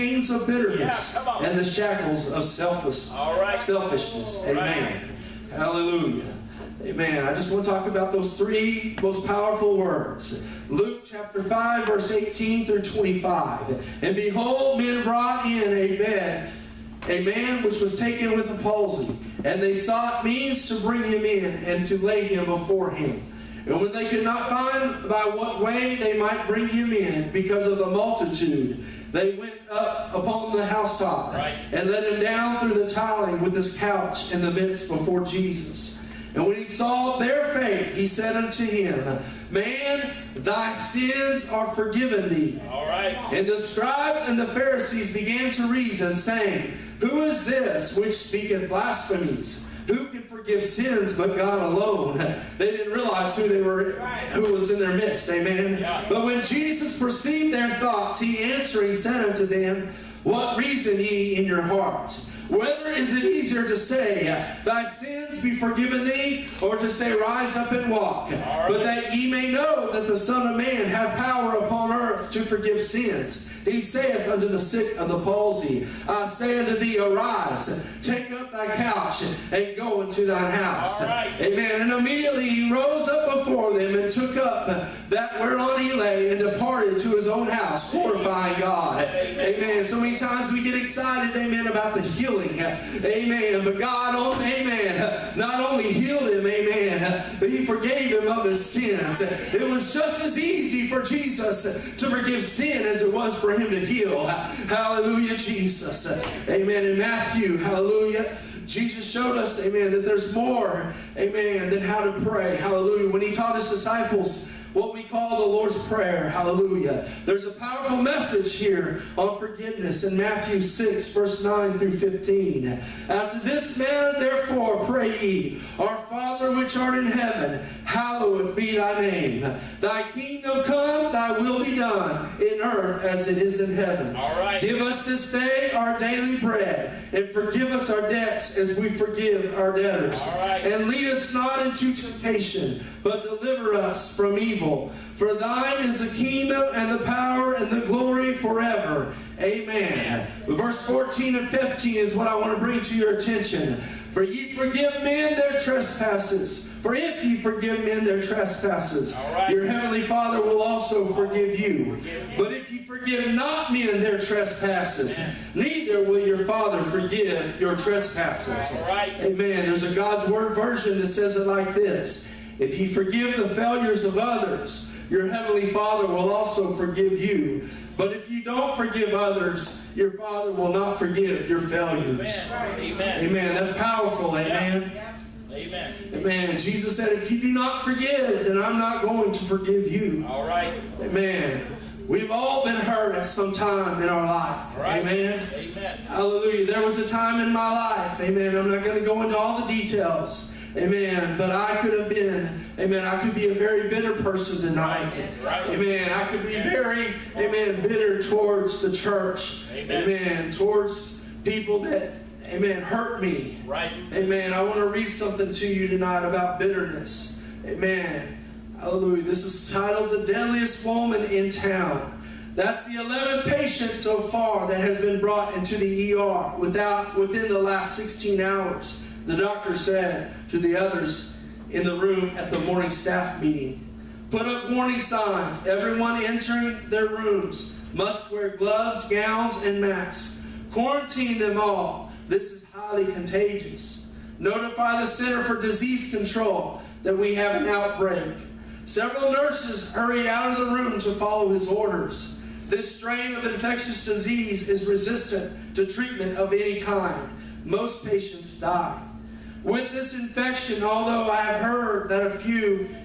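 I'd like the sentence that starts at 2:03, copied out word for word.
After this manner, therefore, pray ye, Our Father which art in heaven, hallowed be thy name.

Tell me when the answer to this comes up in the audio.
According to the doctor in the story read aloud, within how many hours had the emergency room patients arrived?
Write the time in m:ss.
3:47.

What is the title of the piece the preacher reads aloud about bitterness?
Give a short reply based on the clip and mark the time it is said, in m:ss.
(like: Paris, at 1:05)
The Deadliest Woman in Town, at 3:40.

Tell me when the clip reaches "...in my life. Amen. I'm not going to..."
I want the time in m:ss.
3:17.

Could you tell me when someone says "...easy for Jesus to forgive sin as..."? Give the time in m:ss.
1:40.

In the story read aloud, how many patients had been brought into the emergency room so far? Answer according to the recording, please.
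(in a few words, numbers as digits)
11.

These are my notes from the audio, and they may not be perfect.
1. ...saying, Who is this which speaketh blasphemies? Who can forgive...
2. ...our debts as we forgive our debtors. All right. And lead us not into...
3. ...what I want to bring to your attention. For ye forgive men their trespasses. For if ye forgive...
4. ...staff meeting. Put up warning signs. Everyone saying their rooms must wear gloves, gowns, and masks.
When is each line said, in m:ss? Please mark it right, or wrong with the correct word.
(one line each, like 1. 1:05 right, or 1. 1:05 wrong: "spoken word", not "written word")
1. 0:46 right
2. 2:17 right
3. 2:32 right
4. 3:52 wrong: "entering", not "saying".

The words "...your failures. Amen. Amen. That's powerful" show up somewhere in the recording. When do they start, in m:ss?
3:01.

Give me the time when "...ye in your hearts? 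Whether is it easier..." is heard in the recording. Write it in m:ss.
1:00.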